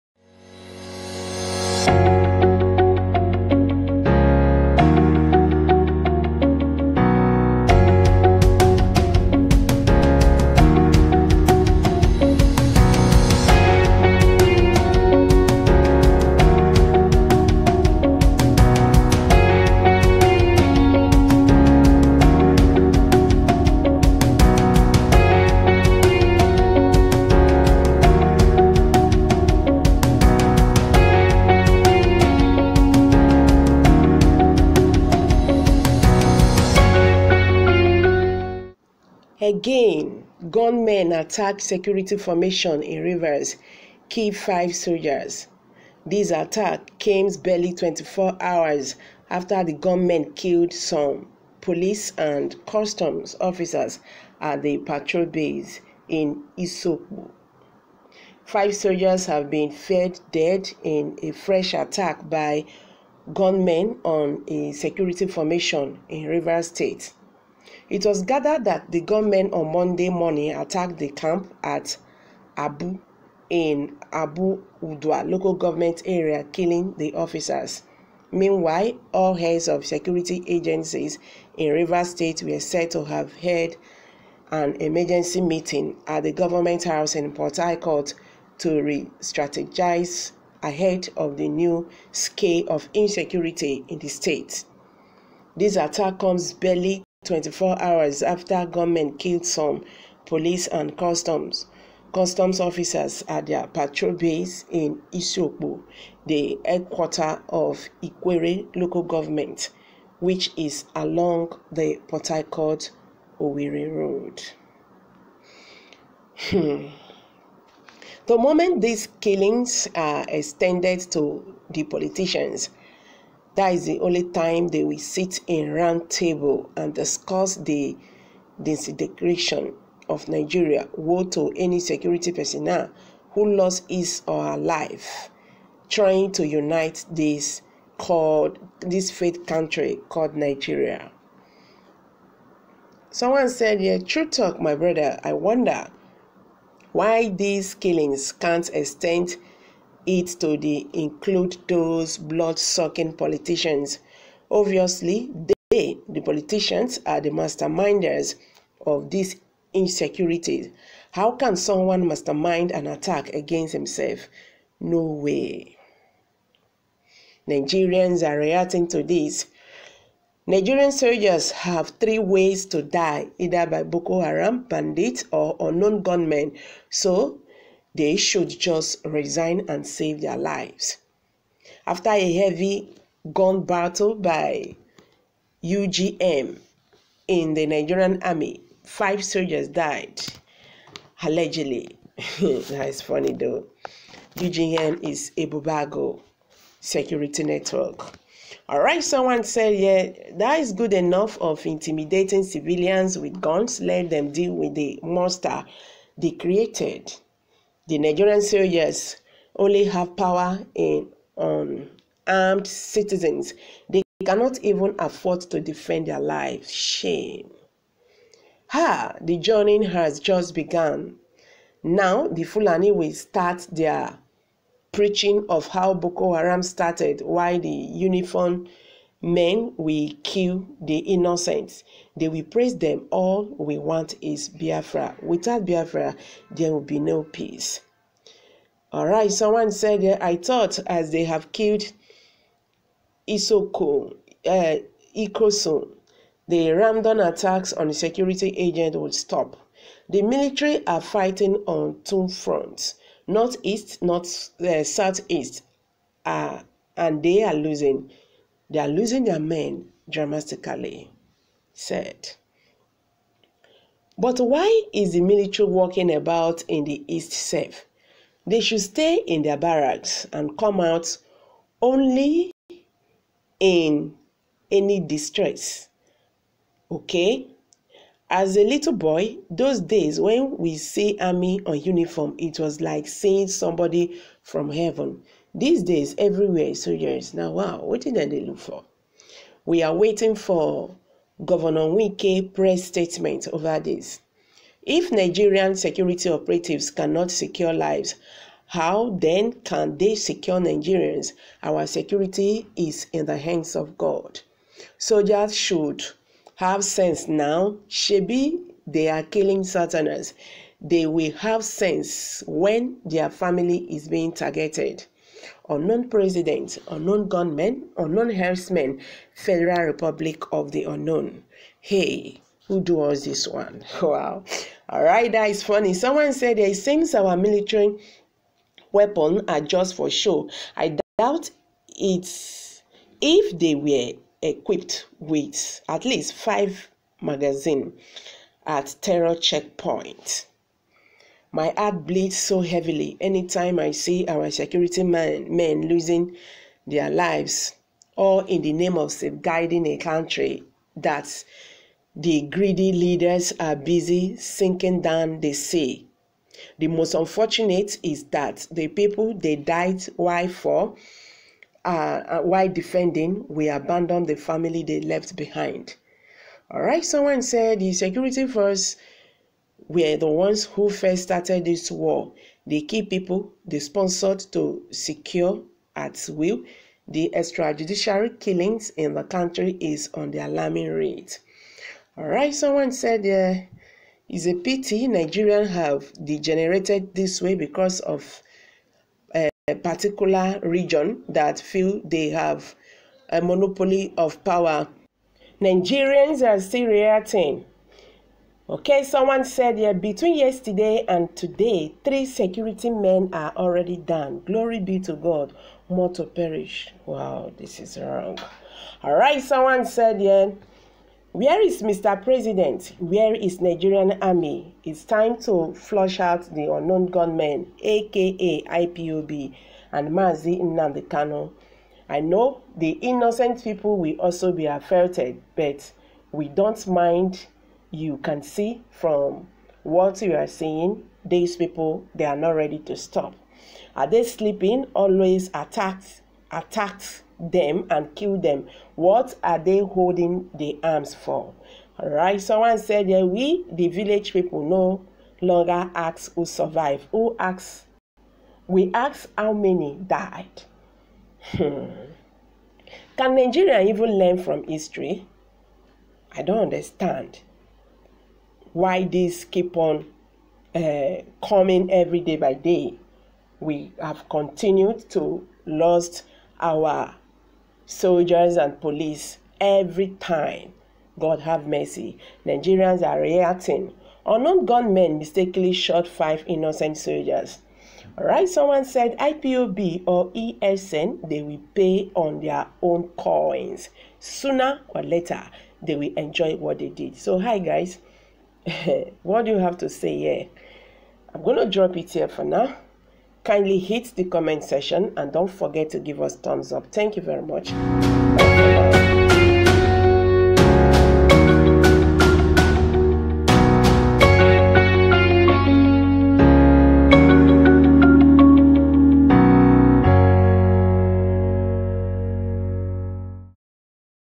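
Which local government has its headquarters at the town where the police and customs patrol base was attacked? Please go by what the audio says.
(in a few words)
Ikwerre.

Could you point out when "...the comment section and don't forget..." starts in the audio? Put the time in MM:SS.
08:14.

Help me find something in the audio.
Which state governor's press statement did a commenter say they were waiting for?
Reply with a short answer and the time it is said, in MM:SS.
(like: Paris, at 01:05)
Wike, at 04:51.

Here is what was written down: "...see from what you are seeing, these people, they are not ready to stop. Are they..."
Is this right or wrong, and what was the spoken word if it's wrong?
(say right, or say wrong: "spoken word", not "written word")
right.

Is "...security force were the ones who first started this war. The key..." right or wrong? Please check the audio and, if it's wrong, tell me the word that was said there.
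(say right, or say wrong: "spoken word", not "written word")
right.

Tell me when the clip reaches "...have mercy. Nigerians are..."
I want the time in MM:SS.
07:51.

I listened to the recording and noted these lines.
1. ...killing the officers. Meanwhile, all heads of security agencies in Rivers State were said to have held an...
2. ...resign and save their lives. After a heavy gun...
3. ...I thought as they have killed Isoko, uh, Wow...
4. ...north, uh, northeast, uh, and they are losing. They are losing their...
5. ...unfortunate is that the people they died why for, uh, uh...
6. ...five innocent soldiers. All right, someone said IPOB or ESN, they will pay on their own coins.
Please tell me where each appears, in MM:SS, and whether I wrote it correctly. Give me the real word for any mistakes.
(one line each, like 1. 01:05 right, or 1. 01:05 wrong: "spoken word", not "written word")
1. 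01:16 right
2. 02:59 right
3. 04:00 wrong: "Ikosun", not "Wow"
4. 04:14 wrong: "southeast", not "northeast"
5. 05:57 right
6. 07:56 right.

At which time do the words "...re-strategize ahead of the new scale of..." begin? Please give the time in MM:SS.
01:28.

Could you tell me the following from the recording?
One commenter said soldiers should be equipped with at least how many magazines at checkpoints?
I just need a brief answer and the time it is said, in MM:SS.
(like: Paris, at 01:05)
5, at 05:36.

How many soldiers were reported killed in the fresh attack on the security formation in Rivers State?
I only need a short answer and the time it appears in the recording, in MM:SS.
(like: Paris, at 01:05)
5, at 00:58.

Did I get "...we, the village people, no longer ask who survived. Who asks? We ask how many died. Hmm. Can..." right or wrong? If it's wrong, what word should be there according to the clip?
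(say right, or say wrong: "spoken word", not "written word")
right.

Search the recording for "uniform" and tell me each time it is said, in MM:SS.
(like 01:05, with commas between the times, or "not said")
03:47, 04:41.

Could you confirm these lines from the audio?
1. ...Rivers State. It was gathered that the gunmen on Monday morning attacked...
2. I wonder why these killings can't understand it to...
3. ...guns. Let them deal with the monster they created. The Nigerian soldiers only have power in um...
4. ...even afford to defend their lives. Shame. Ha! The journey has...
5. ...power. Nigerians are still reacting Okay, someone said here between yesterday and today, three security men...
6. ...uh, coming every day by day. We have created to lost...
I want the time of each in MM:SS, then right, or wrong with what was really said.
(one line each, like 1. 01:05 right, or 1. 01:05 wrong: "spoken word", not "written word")
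1. 01:06 right
2. 02:25 wrong: "extend", not "understand"
3. 03:23 right
4. 03:34 right
5. 06:34 right
6. 07:40 wrong: "continued", not "created".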